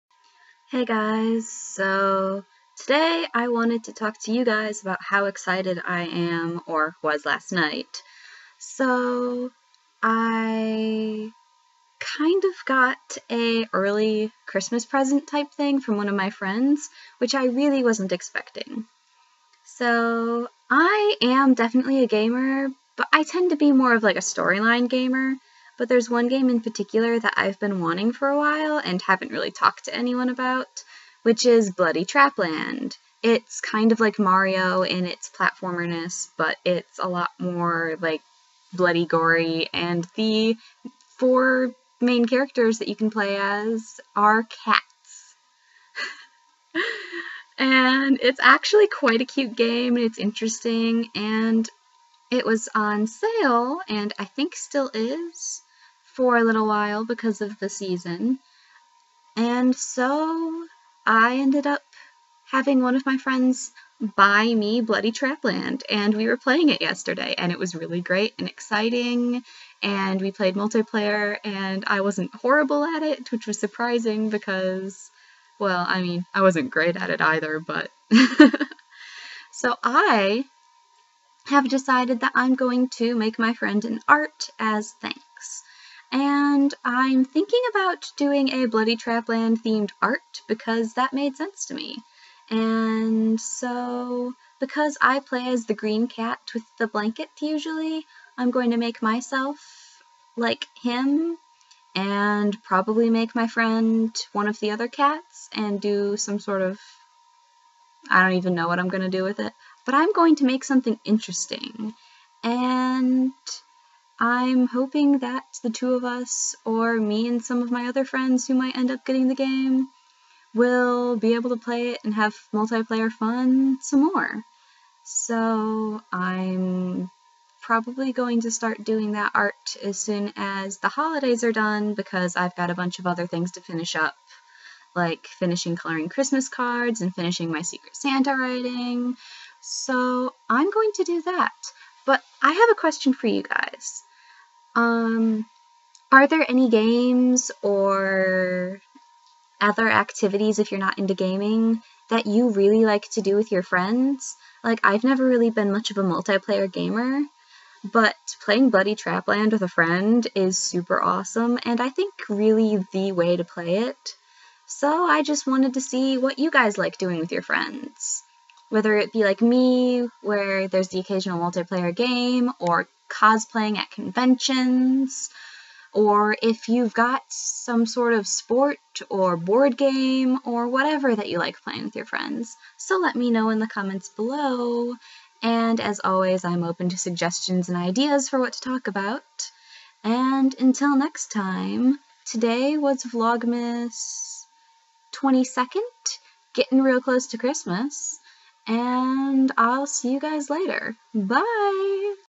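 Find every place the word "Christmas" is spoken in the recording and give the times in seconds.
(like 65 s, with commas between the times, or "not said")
14 s, 136 s, 197 s.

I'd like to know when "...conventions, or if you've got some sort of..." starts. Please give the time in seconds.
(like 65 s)
173 s.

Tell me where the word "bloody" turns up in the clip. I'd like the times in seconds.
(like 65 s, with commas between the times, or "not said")
31 s, 38 s, 64 s, 88 s, 158 s.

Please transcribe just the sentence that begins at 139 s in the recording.
So I'm going to do that.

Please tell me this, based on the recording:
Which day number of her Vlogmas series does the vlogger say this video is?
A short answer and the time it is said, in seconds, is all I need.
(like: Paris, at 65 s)
22nd, at 195 s.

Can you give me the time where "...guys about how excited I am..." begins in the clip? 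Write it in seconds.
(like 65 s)
4 s.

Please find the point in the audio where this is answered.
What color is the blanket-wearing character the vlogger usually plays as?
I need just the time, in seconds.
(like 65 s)
95 s.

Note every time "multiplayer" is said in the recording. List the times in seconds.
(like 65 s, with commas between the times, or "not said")
70 s, 122 s, 156 s, 171 s.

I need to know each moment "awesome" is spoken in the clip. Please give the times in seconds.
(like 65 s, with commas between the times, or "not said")
161 s.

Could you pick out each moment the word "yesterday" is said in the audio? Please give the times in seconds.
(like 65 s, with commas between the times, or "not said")
66 s.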